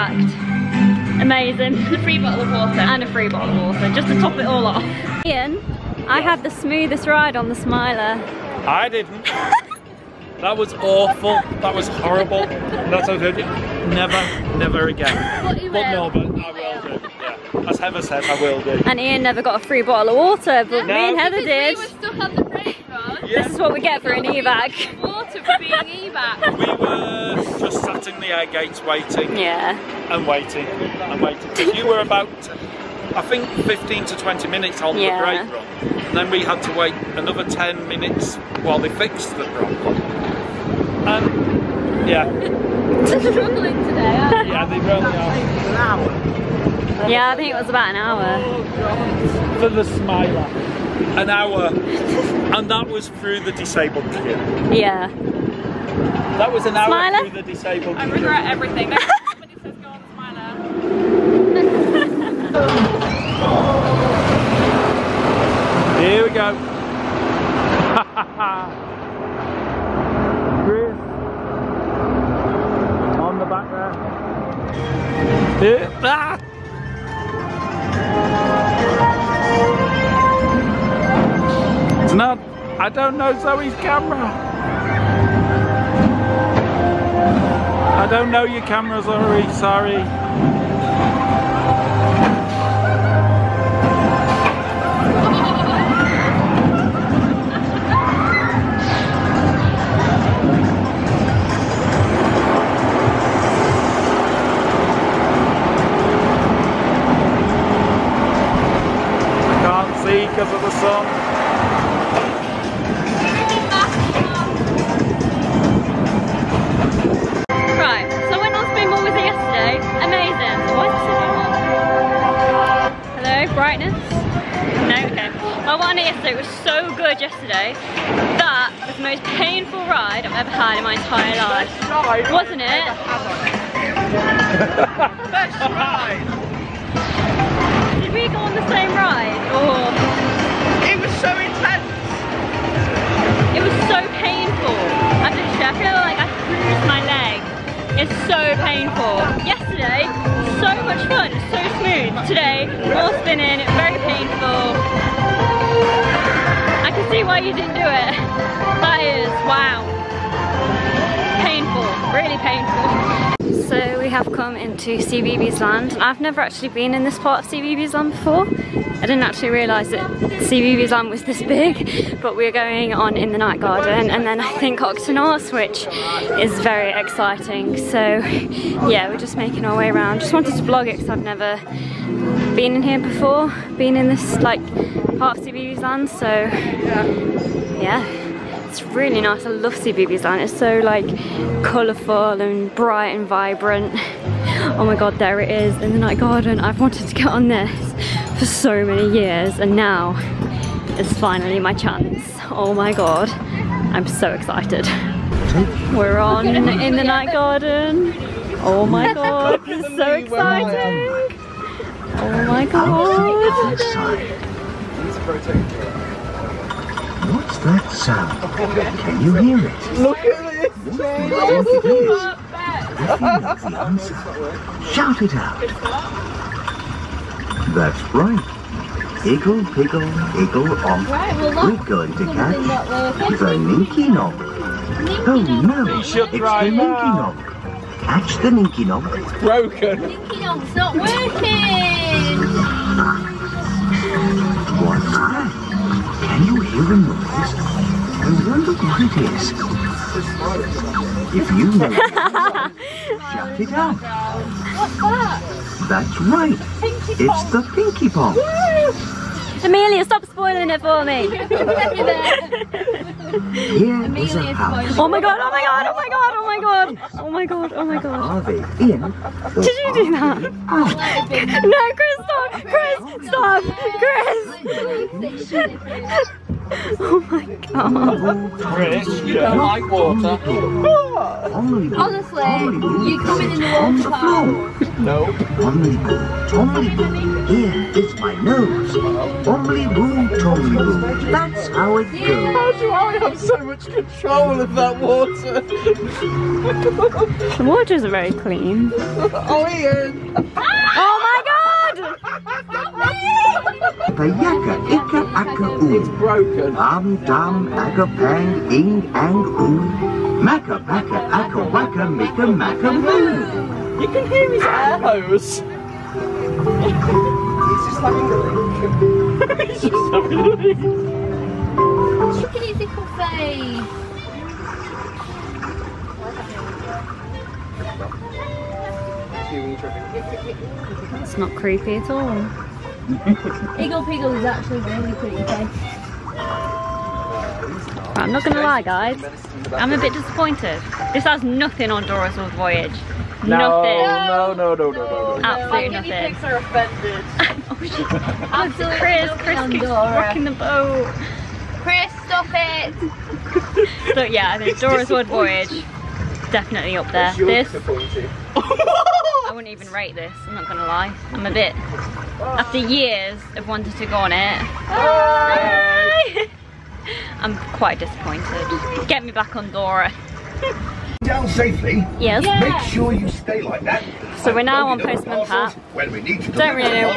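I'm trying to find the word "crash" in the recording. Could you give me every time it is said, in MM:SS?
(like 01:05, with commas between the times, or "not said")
not said.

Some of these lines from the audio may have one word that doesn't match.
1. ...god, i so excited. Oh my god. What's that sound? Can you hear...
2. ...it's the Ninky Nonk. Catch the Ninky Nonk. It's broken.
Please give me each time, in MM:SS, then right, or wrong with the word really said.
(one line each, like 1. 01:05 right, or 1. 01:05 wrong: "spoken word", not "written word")
1. 03:29 right
2. 03:55 right.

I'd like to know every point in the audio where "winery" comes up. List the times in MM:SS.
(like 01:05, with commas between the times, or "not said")
not said.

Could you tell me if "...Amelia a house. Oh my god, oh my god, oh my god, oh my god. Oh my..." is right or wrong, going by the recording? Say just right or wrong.
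right.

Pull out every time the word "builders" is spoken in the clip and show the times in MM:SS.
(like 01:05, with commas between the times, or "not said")
not said.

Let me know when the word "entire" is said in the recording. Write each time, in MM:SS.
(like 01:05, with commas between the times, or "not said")
02:10.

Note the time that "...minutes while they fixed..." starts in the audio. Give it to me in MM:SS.
00:37.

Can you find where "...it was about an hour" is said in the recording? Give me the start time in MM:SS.
00:47.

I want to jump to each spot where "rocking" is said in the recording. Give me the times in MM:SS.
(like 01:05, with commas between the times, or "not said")
05:49.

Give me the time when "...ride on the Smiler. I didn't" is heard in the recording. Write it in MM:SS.
00:07.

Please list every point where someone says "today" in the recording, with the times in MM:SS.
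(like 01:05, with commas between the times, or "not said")
00:43, 02:32.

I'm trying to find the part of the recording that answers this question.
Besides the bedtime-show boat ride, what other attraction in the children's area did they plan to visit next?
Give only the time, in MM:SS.
02:54.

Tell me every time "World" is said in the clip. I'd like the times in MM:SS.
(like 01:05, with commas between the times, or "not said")
05:42, 05:55.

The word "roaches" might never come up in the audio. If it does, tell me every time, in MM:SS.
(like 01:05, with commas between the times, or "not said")
not said.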